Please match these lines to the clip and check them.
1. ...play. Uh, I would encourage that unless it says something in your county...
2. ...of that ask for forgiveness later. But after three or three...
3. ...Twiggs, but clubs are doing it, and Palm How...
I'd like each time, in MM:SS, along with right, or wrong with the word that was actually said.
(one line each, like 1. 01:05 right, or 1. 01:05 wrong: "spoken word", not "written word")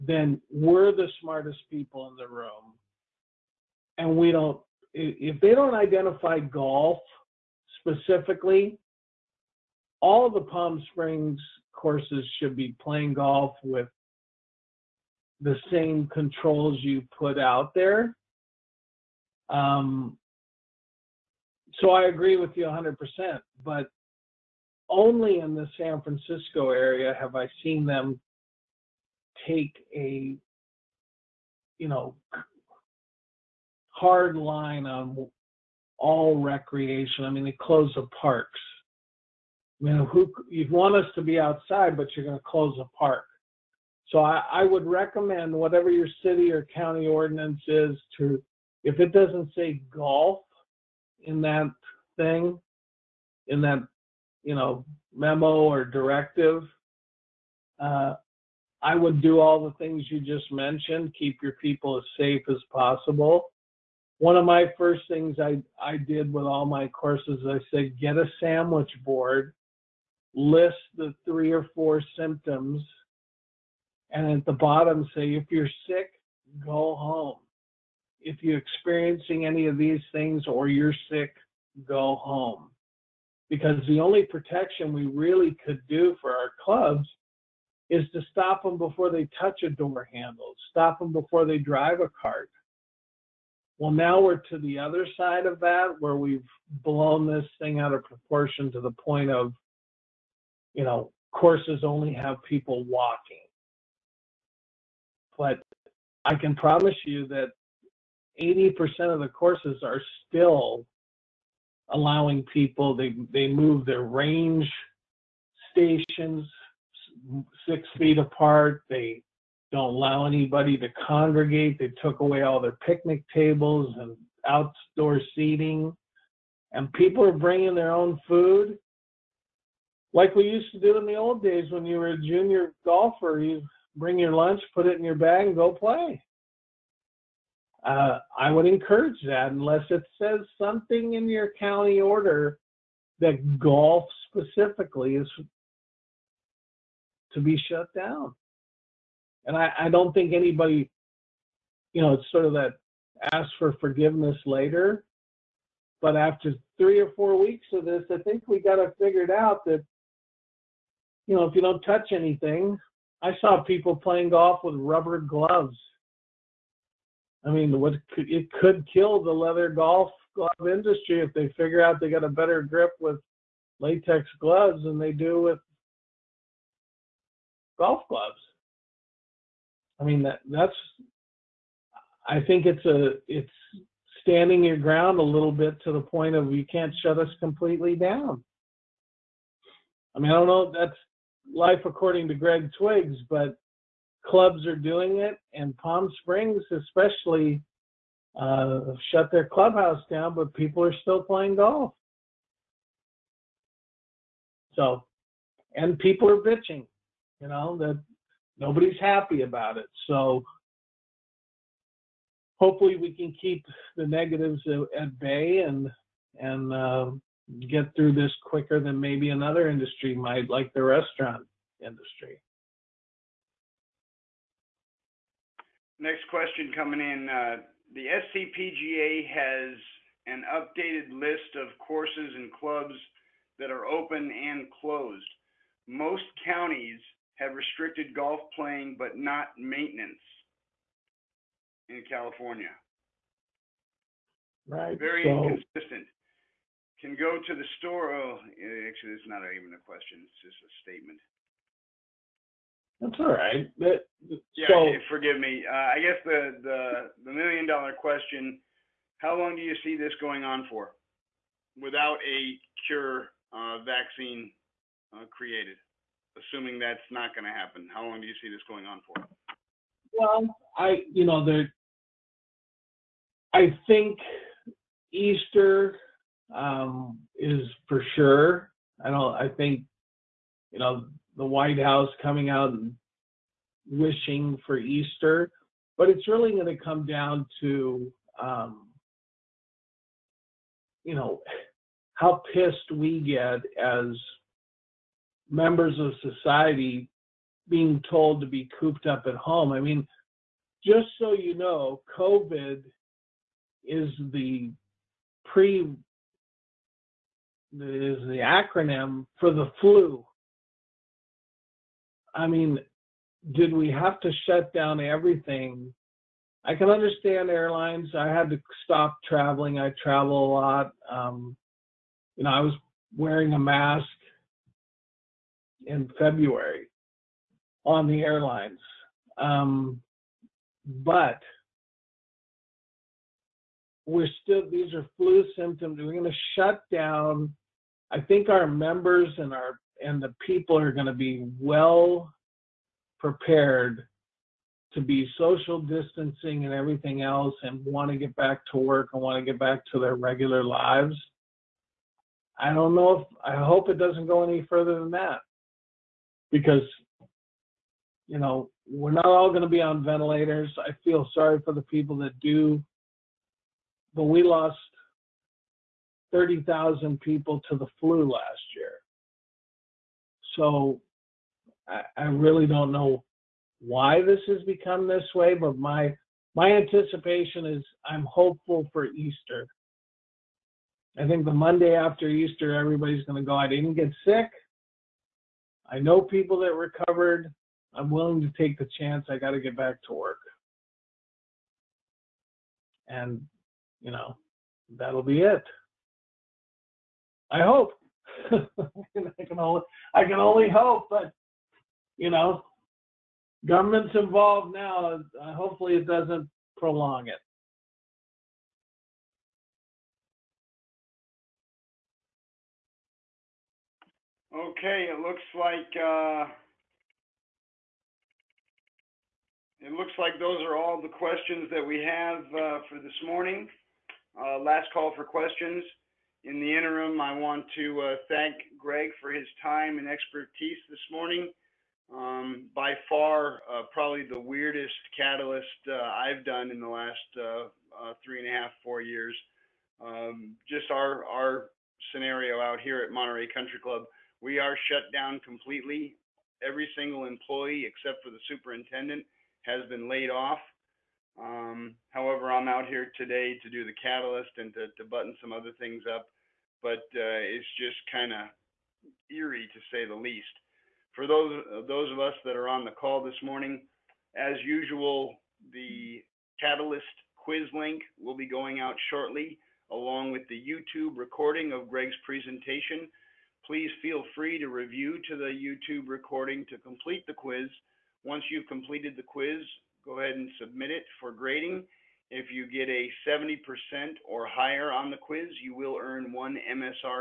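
1. 02:15 right
2. 02:32 wrong: "four", not "three"
3. 03:12 wrong: "Springs", not "How".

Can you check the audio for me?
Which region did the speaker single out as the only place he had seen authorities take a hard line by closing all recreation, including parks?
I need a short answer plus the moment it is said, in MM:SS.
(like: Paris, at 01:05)
San Francisco, at 00:25.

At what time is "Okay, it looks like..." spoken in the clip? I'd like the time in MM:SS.
06:54.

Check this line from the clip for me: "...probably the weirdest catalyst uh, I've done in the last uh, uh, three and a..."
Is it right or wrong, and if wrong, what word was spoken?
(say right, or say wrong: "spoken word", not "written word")
right.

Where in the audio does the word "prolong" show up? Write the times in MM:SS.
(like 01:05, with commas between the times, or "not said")
06:46.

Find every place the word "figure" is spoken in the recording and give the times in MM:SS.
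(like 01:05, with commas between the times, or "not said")
02:39, 02:51.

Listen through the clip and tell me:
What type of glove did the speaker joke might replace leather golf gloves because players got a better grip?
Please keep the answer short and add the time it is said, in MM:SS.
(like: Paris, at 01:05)
Latex gloves, at 02:53.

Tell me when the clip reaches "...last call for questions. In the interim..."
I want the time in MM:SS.
07:04.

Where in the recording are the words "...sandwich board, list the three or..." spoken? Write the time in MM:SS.
01:08.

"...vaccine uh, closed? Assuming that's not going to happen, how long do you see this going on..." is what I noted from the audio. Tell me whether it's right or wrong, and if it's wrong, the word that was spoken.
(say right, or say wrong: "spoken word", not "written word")
wrong: "created", not "closed".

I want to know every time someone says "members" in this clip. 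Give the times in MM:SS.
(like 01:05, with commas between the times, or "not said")
04:55, 05:38.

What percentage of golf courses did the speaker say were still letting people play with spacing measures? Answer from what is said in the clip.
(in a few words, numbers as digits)
80%.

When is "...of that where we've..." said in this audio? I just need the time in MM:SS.
01:35.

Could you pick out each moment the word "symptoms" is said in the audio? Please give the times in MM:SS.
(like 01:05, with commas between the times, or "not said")
01:12, 05:35.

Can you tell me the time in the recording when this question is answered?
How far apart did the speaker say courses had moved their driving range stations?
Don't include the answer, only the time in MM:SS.
01:57.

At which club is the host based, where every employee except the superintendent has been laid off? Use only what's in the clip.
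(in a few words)
Monterey Country Club.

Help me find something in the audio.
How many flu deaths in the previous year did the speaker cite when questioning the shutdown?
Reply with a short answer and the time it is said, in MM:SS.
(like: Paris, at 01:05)
30,000, at 06:06.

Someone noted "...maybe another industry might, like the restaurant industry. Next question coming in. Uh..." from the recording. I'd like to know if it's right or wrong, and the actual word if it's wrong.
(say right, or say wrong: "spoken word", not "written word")
right.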